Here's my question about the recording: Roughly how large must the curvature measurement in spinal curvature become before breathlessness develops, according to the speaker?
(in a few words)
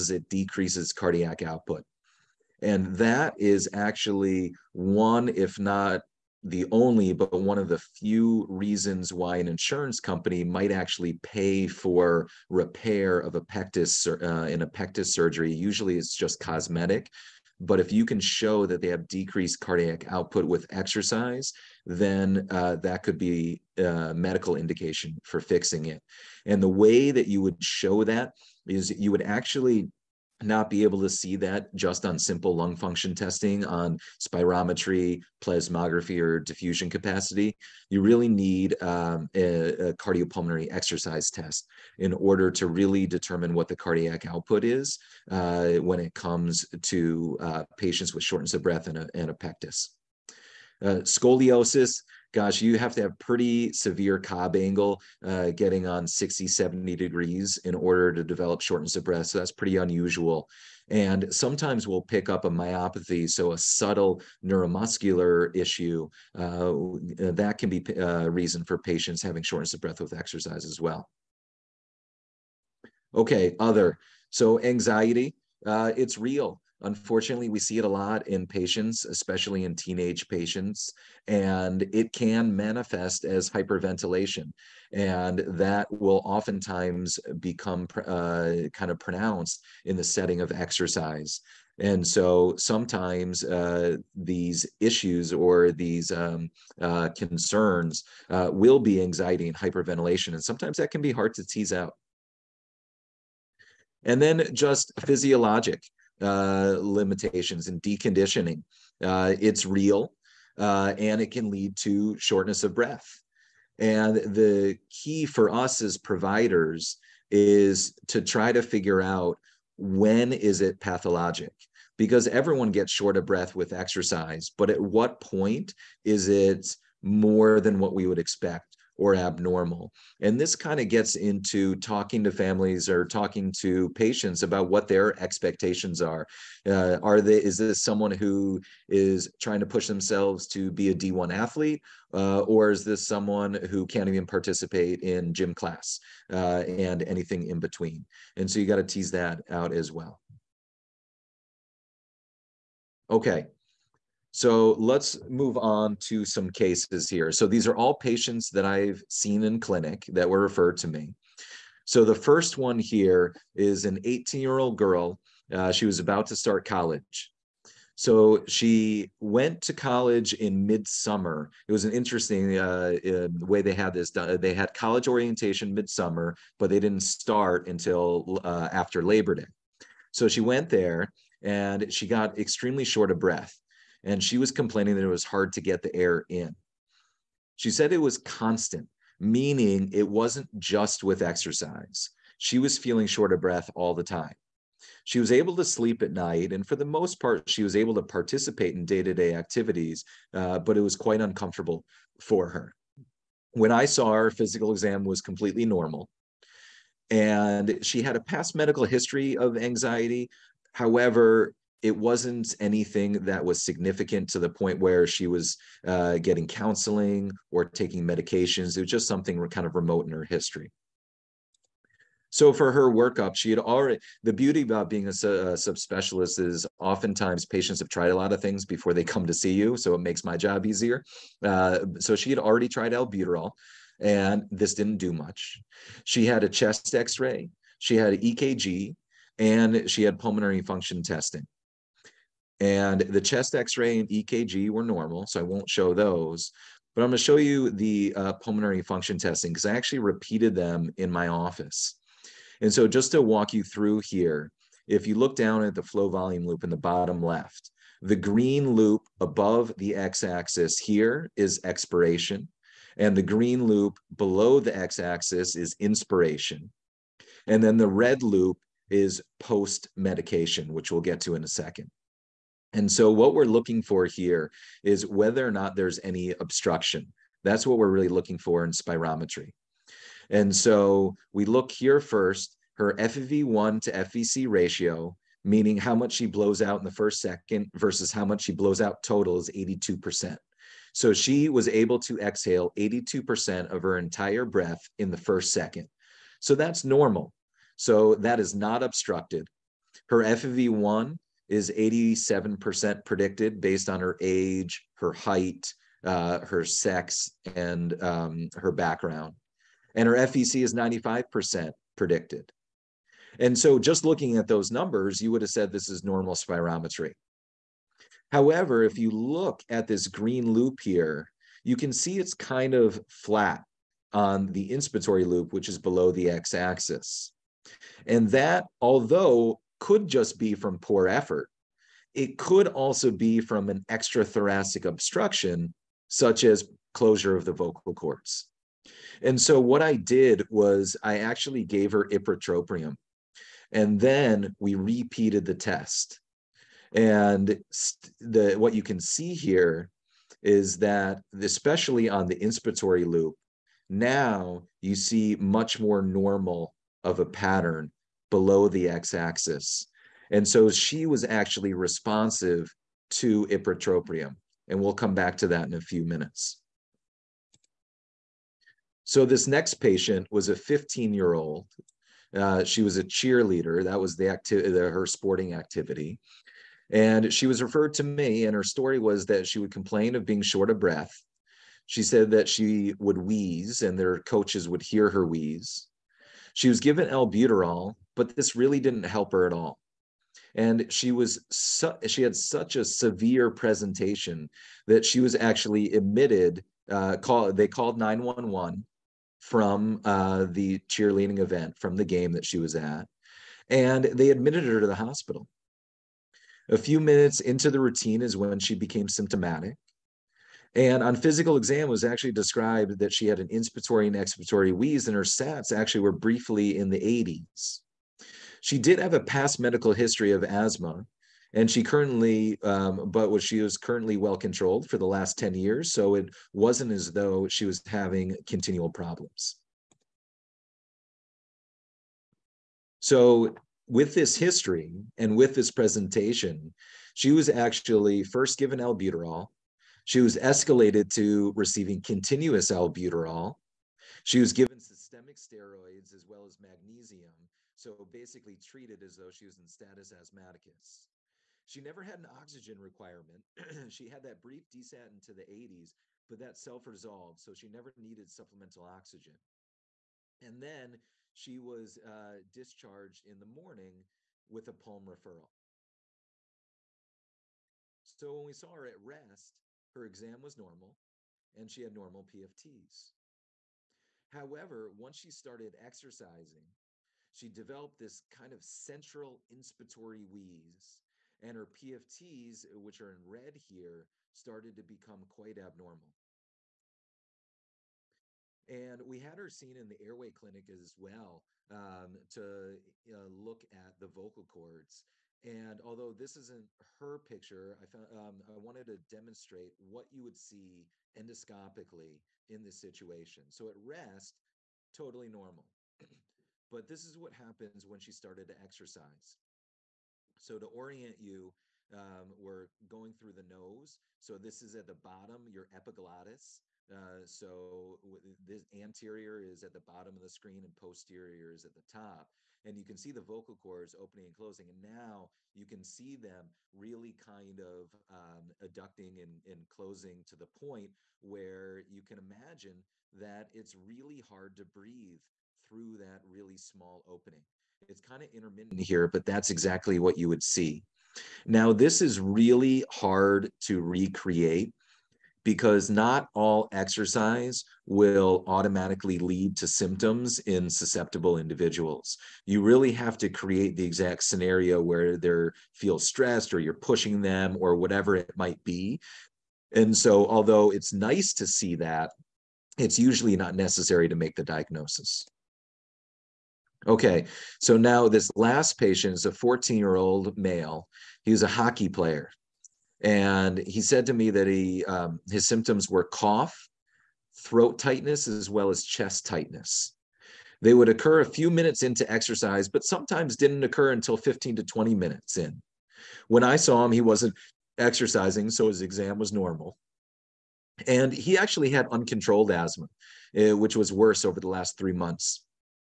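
60 to 70 degrees.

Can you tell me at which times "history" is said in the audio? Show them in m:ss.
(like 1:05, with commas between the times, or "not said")
3:28, 3:40, 6:59, 7:14.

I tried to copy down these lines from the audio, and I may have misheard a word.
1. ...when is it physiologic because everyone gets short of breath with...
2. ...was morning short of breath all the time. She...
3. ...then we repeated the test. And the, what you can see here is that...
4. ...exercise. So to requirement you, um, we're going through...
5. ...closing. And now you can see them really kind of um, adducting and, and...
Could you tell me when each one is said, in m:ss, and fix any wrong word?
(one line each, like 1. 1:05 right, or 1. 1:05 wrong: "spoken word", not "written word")
1. 1:59 wrong: "pathologic", not "physiologic"
2. 3:12 wrong: "feeling", not "morning"
3. 5:43 right
4. 8:28 wrong: "orient", not "requirement"
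5. 8:44 right.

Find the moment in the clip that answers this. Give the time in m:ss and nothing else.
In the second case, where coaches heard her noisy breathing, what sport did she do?
6:13.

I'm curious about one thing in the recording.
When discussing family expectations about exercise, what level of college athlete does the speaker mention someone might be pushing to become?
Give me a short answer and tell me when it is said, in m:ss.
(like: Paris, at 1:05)
D1, at 2:20.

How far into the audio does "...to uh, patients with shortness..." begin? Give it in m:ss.
0:46.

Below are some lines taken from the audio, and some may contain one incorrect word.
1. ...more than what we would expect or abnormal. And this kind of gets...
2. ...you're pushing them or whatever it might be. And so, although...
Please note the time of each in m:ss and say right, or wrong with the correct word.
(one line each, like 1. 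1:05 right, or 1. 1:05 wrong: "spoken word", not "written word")
1. 2:07 right
2. 9:16 right.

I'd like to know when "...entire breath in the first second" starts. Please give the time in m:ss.
4:53.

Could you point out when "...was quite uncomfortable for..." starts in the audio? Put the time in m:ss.
3:20.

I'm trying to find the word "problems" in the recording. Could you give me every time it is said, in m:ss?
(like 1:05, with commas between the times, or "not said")
7:08.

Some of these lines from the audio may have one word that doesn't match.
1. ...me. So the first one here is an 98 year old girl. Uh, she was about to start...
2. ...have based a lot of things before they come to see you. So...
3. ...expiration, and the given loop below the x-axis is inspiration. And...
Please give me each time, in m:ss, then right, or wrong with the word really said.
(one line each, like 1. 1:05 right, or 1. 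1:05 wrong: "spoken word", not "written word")
1. 2:40 wrong: "18", not "98"
2. 3:47 wrong: "tried", not "based"
3. 4:21 wrong: "green", not "given".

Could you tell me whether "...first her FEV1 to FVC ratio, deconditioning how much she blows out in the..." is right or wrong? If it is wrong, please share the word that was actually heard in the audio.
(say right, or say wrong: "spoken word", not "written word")
wrong: "meaning", not "deconditioning".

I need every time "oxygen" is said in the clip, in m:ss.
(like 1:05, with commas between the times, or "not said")
7:32, 7:38.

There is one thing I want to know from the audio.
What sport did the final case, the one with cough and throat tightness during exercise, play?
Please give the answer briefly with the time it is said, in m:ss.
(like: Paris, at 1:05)
Hockey, at 9:31.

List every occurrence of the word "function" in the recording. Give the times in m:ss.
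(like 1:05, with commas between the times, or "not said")
0:32, 4:00, 4:08.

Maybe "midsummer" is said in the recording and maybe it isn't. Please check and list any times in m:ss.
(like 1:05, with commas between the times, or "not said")
2:50, 2:55.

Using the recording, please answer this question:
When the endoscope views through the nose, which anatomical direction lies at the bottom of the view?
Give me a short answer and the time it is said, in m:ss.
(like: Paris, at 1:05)
Anterior, at 8:38.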